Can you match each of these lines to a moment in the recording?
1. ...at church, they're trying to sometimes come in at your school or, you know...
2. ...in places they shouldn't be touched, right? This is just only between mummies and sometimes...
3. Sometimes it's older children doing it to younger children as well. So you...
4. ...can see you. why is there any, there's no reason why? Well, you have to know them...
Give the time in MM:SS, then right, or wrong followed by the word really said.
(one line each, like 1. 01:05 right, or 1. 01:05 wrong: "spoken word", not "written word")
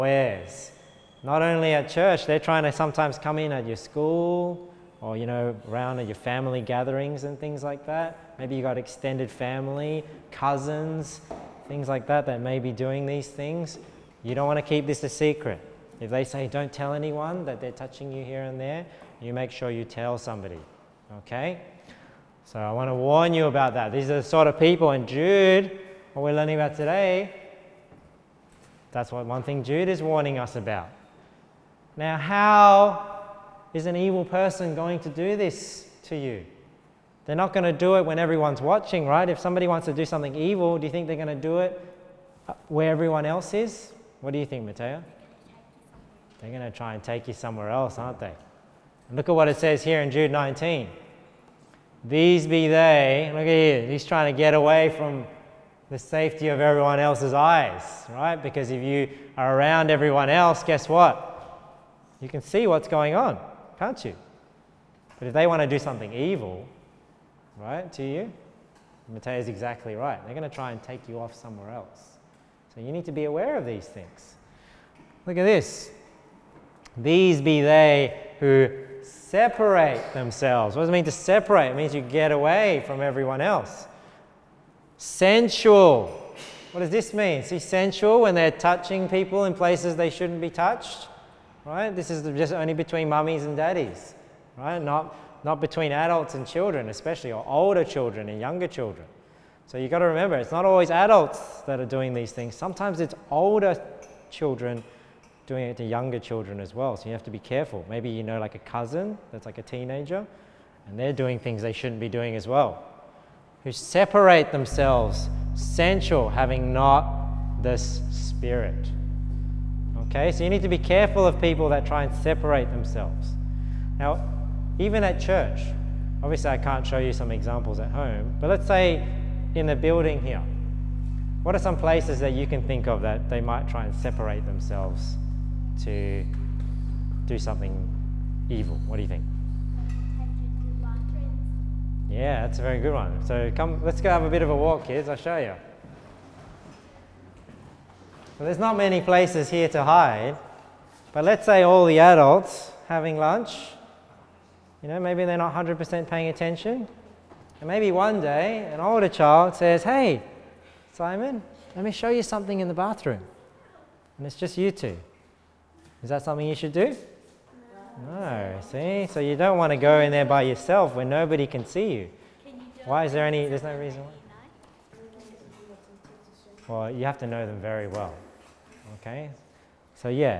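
1. 00:01 right
2. 01:29 wrong: "daddies", not "sometimes"
3. 01:42 right
4. 02:51 right.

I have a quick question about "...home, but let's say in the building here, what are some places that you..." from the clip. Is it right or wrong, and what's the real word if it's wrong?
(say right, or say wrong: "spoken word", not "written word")
right.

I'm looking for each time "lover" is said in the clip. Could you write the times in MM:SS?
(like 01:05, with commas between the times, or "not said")
not said.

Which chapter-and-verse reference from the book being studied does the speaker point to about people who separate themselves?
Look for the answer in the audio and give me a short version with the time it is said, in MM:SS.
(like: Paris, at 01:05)
Jude 19, at 00:50.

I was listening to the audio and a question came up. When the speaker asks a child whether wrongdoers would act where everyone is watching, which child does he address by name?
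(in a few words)
Mateo.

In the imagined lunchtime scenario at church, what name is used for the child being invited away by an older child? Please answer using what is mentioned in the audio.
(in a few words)
Simon.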